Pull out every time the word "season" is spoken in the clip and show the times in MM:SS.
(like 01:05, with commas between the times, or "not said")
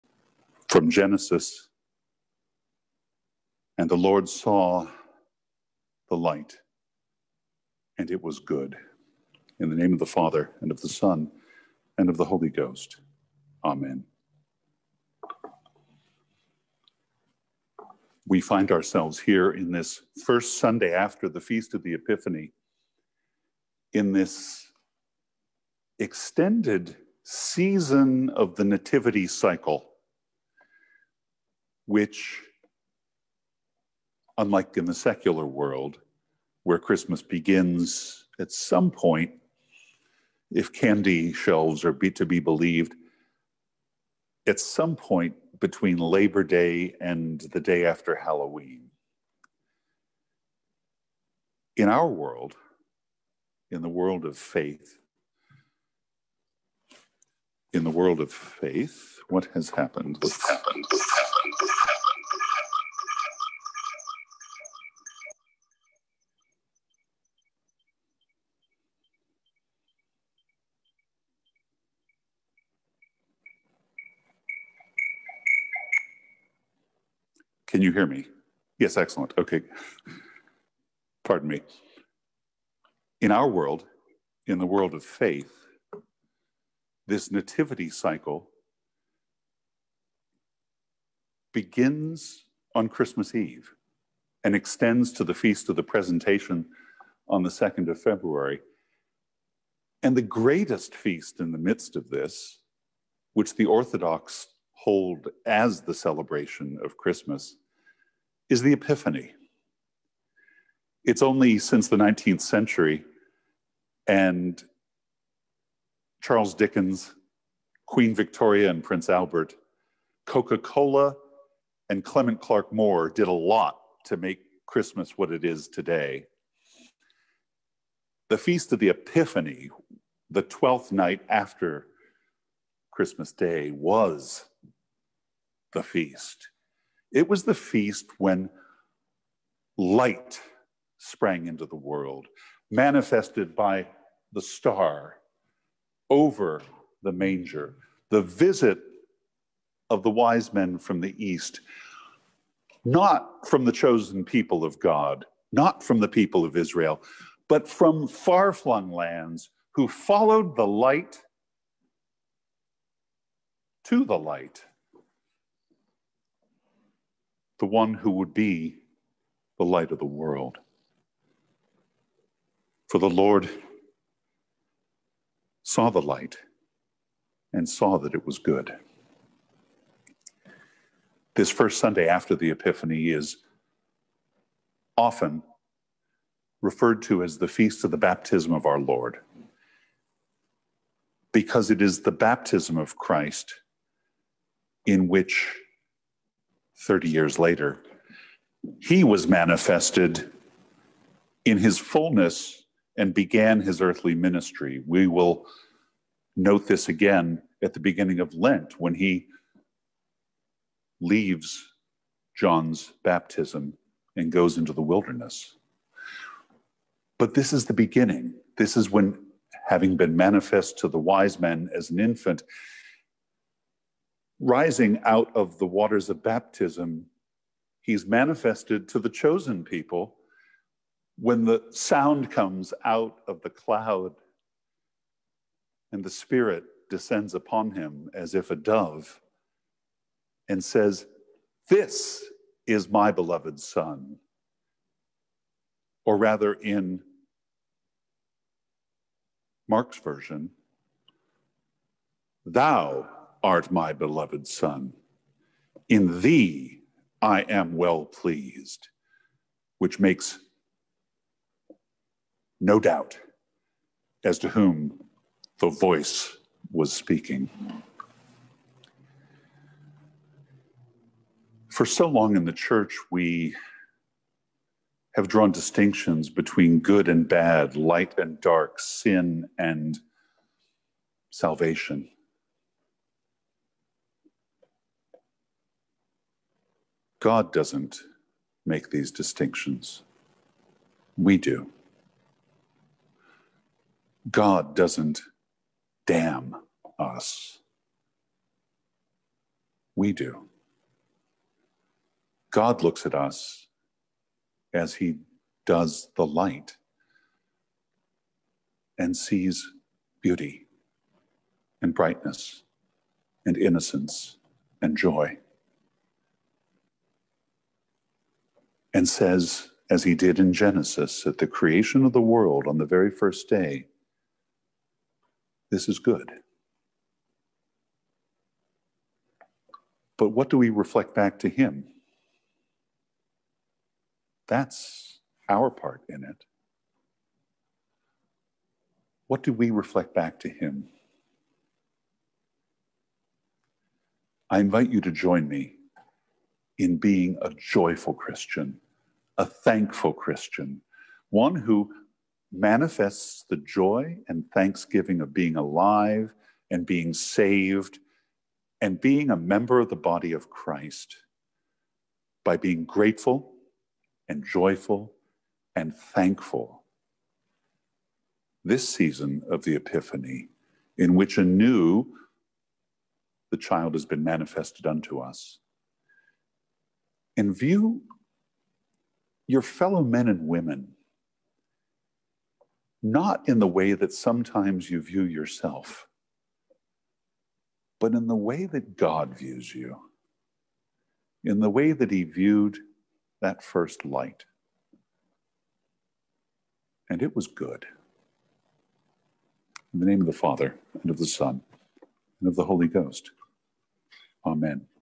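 00:27, 06:08.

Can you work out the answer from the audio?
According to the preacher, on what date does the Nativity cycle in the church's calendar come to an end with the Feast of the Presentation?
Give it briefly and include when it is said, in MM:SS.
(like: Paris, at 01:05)
2nd of February, at 01:37.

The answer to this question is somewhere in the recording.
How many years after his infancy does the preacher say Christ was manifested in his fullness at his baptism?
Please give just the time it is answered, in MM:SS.
03:16.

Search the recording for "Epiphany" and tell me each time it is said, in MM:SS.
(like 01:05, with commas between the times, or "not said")
00:21, 01:48, 02:08, 03:02, 06:09.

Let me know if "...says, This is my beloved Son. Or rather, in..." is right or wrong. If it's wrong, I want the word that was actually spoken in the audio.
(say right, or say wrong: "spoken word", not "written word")
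right.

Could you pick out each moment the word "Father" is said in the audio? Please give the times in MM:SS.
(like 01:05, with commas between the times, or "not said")
00:10, 06:40.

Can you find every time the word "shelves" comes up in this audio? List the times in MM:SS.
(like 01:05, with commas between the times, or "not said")
00:41.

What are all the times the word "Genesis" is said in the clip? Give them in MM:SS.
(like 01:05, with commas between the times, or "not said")
00:00, 05:20.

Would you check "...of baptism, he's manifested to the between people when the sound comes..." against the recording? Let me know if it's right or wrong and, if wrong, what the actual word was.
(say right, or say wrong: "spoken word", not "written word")
wrong: "chosen", not "between".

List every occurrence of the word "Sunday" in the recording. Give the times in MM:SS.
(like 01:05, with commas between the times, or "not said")
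00:20, 03:01.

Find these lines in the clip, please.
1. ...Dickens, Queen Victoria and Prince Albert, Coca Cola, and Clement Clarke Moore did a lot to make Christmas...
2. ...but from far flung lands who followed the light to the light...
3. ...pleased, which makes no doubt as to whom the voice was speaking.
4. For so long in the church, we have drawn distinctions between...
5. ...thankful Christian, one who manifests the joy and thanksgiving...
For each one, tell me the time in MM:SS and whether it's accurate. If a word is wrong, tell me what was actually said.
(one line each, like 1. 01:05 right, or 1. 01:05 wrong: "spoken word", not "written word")
1. 01:56 right
2. 02:37 right
3. 04:18 right
4. 04:31 right
5. 05:49 right.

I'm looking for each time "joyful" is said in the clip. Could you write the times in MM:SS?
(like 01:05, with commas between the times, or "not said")
05:47, 06:04.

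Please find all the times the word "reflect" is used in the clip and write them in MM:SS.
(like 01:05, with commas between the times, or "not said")
05:30, 05:39.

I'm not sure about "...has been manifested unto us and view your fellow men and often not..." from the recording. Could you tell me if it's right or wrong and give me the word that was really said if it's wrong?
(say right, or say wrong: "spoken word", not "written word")
wrong: "women", not "often".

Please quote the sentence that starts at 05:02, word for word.
God looks at us as he does the light and sees beauty and brightness and innocence and joy.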